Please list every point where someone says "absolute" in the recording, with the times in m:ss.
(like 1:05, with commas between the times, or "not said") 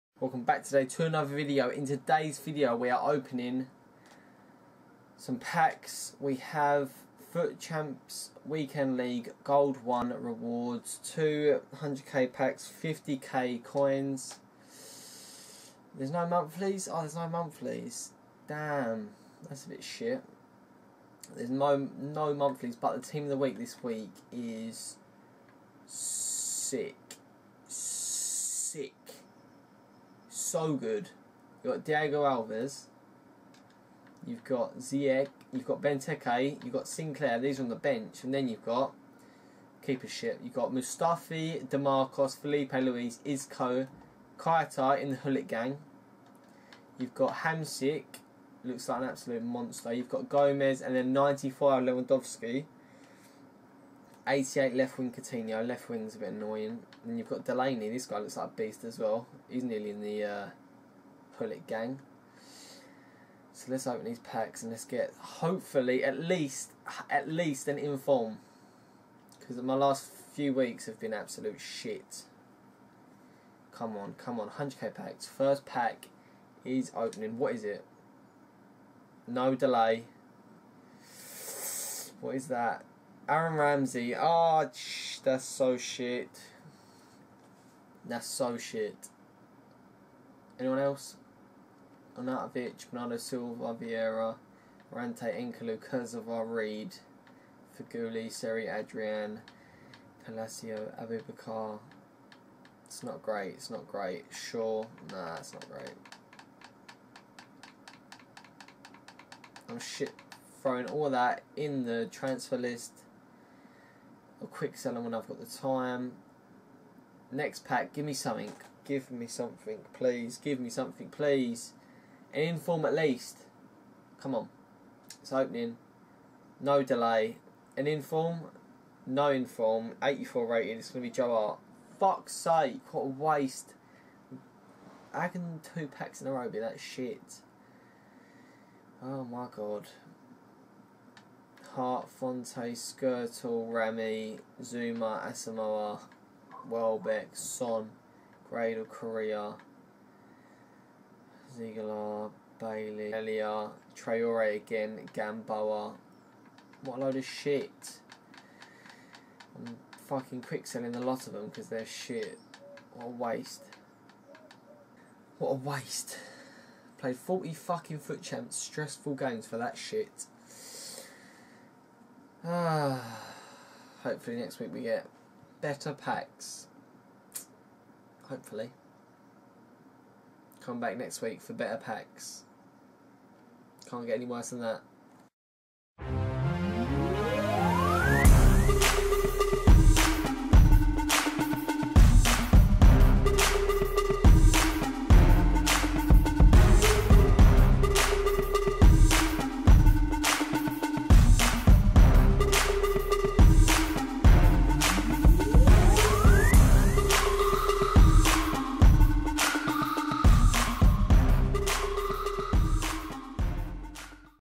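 0:49, 1:11.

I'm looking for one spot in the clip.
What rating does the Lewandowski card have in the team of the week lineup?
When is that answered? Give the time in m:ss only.
0:51.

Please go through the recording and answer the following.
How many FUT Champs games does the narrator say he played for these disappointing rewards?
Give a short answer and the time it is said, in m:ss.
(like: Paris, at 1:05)
40, at 2:47.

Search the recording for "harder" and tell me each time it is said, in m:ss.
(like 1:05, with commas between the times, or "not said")
not said.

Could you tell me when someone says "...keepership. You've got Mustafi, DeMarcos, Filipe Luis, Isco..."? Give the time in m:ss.
0:39.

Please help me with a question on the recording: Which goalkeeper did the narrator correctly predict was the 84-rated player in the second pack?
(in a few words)
Joe Hart.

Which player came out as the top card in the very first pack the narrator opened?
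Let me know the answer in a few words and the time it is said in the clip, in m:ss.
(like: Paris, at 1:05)
Aaron Ramsey, at 1:23.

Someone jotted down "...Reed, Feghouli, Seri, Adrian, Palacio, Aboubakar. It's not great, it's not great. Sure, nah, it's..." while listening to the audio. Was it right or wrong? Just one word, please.
right.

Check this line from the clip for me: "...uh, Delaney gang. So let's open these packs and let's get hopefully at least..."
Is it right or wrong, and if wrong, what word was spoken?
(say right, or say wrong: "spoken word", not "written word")
wrong: "Pullet", not "Delaney".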